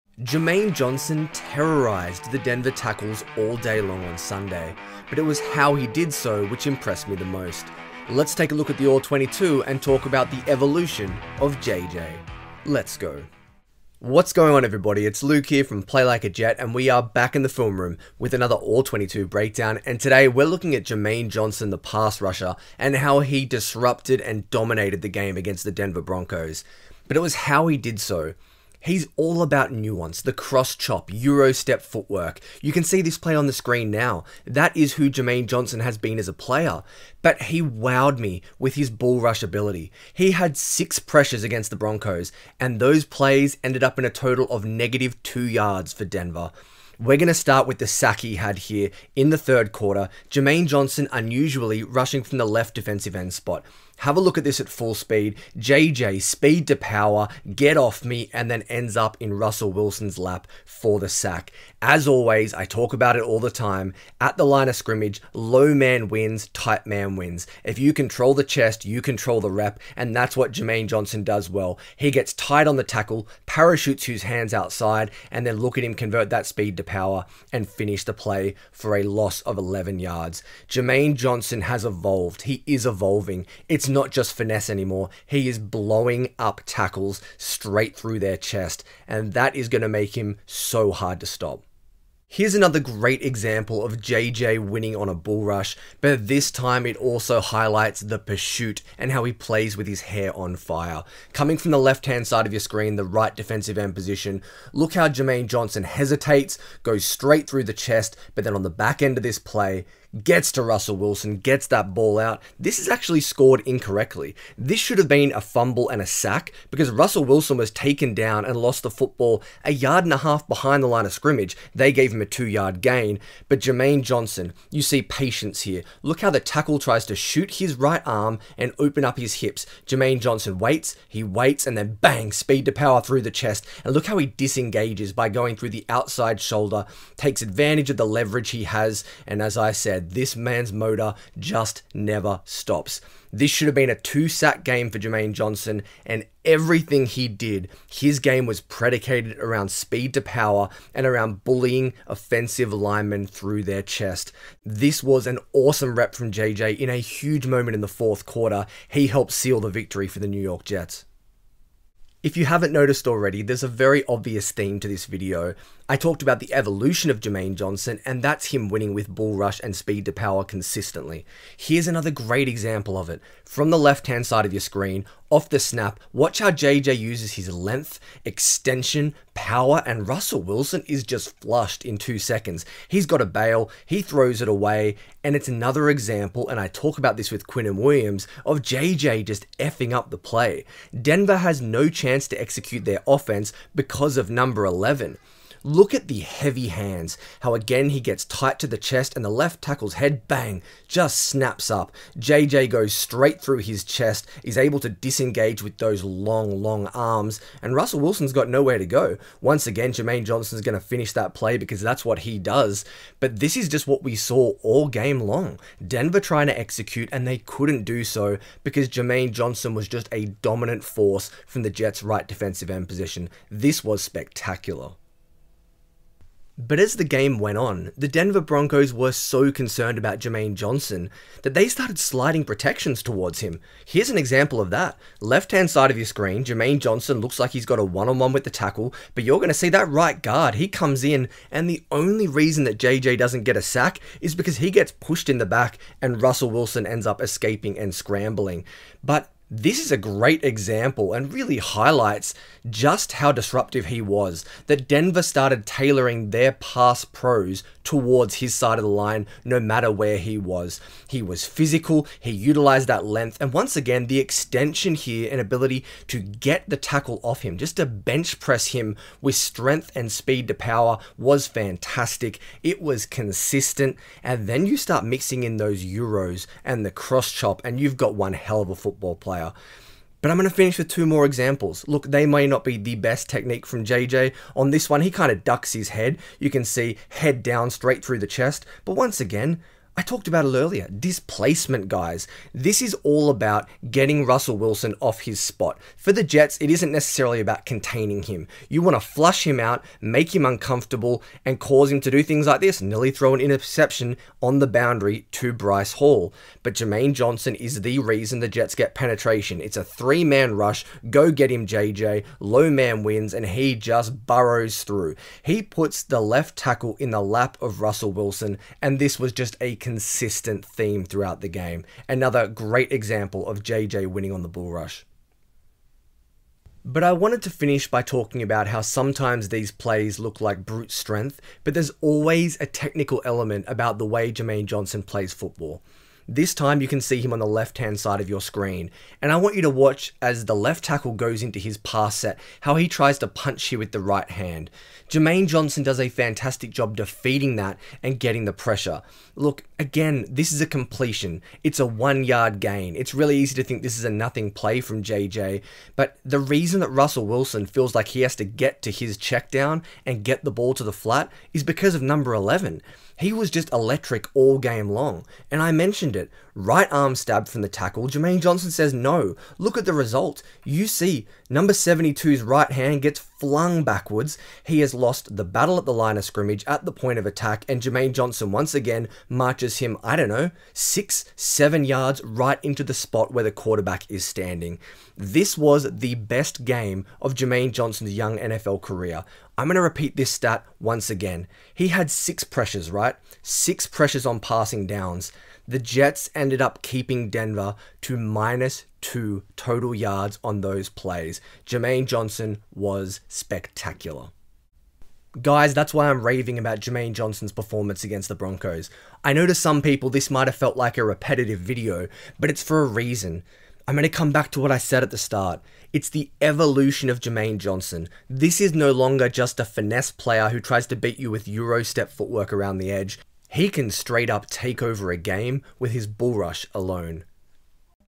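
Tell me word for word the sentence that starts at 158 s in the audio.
He helped seal the victory for the New York Jets.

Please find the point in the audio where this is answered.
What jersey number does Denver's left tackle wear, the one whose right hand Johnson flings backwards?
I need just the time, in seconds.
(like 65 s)
371 s.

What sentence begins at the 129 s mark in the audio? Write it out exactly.
Jermaine Johnson waits, he waits, and then bang, speed to power through the chest.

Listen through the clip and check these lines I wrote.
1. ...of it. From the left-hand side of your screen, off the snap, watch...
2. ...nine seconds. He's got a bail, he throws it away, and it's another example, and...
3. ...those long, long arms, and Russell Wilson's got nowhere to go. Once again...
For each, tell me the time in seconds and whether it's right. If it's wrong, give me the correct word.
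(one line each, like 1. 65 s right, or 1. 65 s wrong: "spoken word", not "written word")
1. 172 s right
2. 181 s wrong: "two", not "nine"
3. 205 s right.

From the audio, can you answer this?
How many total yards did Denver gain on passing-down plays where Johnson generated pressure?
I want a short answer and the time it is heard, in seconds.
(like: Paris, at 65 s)
-2 yards, at 398 s.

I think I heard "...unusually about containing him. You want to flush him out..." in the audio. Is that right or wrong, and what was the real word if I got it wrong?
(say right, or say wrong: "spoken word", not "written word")
wrong: "necessarily", not "unusually".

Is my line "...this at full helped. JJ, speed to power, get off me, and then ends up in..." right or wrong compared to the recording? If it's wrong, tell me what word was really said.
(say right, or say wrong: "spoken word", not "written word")
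wrong: "speed", not "helped".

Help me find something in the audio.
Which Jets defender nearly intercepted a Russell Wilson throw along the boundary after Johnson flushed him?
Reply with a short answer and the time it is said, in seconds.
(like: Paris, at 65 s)
Bryce Hall, at 305 s.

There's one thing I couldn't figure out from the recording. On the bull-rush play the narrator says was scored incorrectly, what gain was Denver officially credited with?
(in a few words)
2 yard gain.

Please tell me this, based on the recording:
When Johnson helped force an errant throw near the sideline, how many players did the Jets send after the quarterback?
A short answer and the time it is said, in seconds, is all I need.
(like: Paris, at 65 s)
3, at 309 s.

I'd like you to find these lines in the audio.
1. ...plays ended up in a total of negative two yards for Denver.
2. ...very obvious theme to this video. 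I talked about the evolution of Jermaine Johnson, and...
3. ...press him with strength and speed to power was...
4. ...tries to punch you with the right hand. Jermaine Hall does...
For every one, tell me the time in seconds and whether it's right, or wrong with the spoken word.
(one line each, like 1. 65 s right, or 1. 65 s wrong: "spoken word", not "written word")
1. 43 s right
2. 163 s right
3. 268 s right
4. 342 s wrong: "Johnson", not "Hall".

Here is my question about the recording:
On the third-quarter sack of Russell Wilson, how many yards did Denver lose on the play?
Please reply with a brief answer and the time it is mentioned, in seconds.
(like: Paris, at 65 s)
11 yards, at 79 s.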